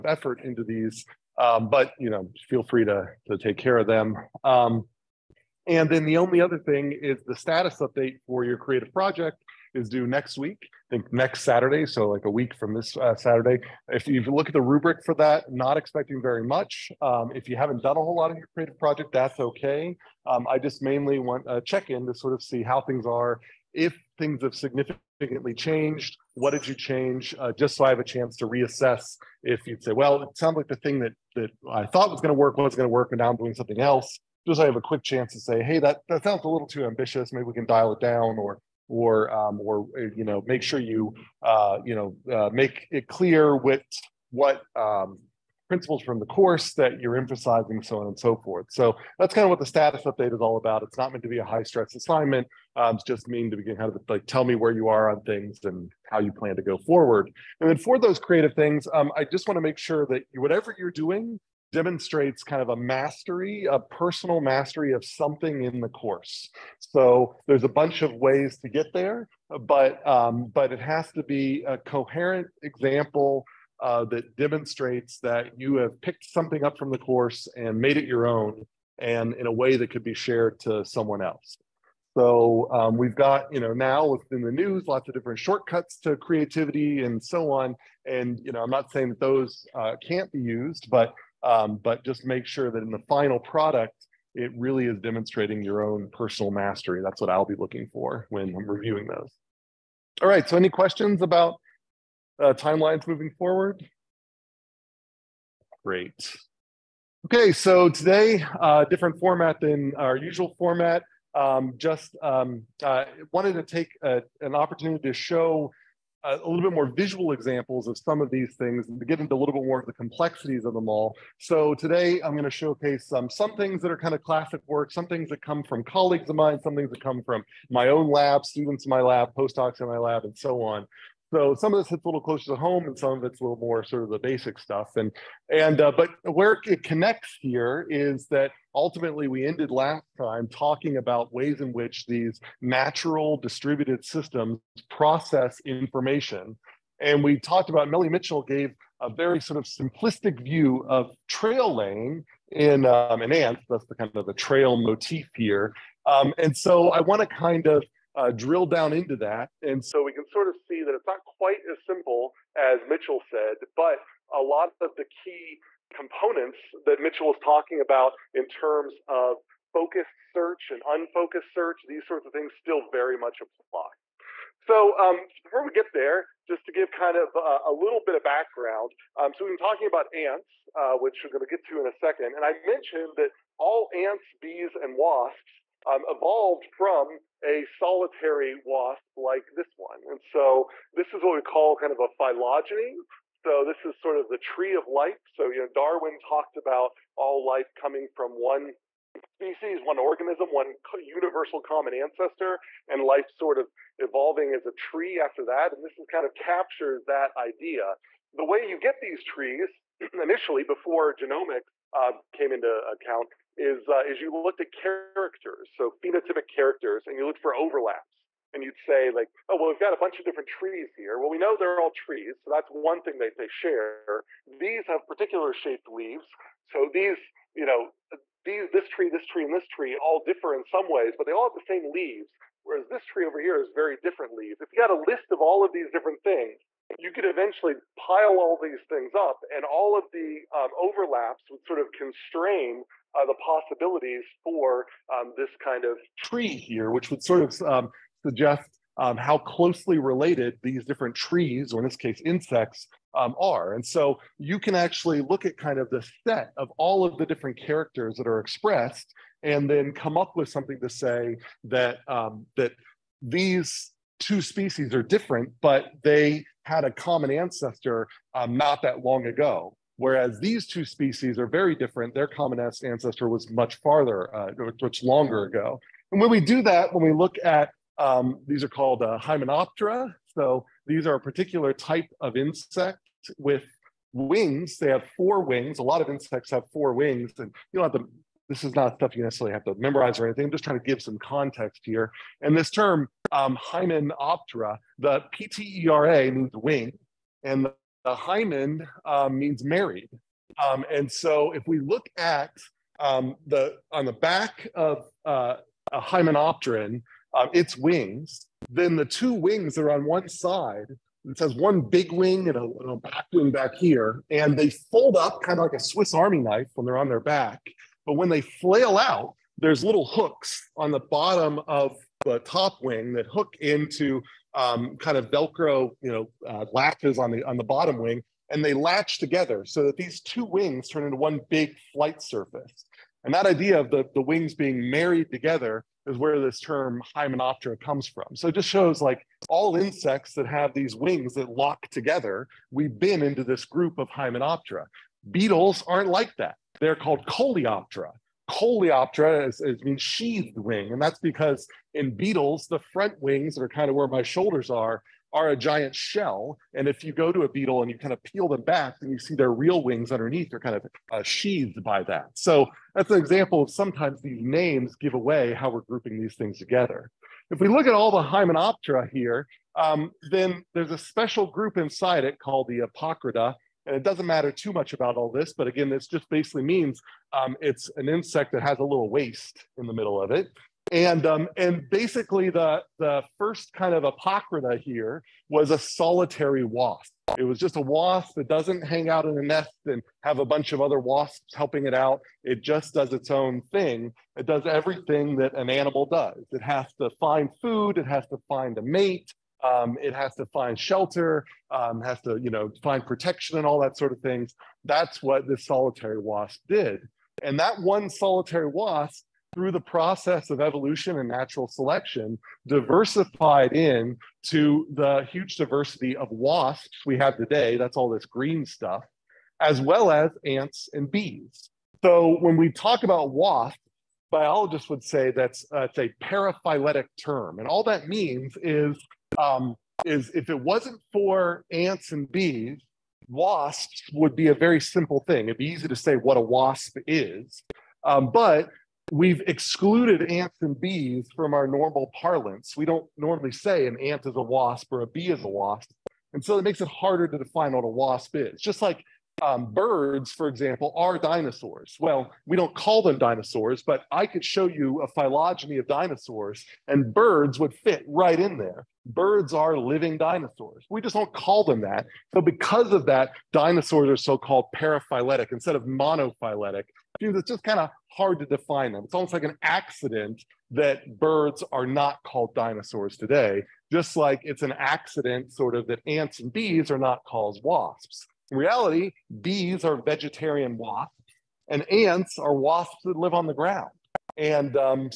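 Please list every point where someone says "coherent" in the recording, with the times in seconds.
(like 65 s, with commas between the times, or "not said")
71 s.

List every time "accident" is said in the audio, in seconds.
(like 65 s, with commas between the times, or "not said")
469 s, 474 s.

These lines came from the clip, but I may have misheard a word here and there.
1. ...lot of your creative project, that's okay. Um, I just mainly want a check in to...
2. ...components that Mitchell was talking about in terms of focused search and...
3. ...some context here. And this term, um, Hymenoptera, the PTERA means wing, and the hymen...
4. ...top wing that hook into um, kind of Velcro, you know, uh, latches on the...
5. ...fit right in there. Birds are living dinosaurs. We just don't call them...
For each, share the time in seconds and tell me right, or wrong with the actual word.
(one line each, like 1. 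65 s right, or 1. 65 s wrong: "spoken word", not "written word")
1. 18 s right
2. 165 s right
3. 291 s right
4. 322 s right
5. 457 s right.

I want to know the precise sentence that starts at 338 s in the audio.
So it just shows like all insects that have these wings that lock together, we've been into this group of hymenoptera.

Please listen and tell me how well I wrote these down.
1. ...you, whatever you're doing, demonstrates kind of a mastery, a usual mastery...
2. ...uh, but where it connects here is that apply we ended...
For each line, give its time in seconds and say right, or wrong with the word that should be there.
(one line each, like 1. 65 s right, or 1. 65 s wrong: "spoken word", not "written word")
1. 60 s wrong: "personal", not "usual"
2. 135 s wrong: "ultimately", not "apply".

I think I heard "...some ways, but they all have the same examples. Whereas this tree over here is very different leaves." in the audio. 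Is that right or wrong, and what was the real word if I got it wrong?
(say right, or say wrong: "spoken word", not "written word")
wrong: "leaves", not "examples".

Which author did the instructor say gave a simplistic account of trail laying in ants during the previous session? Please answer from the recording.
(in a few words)
Melanie Mitchell.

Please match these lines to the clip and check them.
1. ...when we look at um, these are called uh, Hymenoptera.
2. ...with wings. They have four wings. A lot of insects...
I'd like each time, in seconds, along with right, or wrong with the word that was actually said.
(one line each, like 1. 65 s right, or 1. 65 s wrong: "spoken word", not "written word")
1. 276 s right
2. 283 s right.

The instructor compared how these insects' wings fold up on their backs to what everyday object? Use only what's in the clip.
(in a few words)
Swiss Army knife.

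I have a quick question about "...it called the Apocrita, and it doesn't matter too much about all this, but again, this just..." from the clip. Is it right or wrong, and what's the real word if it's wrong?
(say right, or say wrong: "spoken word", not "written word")
right.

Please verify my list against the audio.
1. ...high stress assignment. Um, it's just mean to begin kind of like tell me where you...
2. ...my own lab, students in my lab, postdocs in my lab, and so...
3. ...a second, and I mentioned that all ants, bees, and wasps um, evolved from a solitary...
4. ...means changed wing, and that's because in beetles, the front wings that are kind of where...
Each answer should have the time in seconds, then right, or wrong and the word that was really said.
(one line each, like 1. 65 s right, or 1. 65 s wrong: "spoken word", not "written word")
1. 51 s right
2. 127 s right
3. 181 s right
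4. 349 s wrong: "sheathed", not "changed".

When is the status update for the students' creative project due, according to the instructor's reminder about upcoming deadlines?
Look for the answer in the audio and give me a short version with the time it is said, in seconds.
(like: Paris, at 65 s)
Next Saturday, at 11 s.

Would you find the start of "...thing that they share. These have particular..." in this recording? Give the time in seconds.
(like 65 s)
223 s.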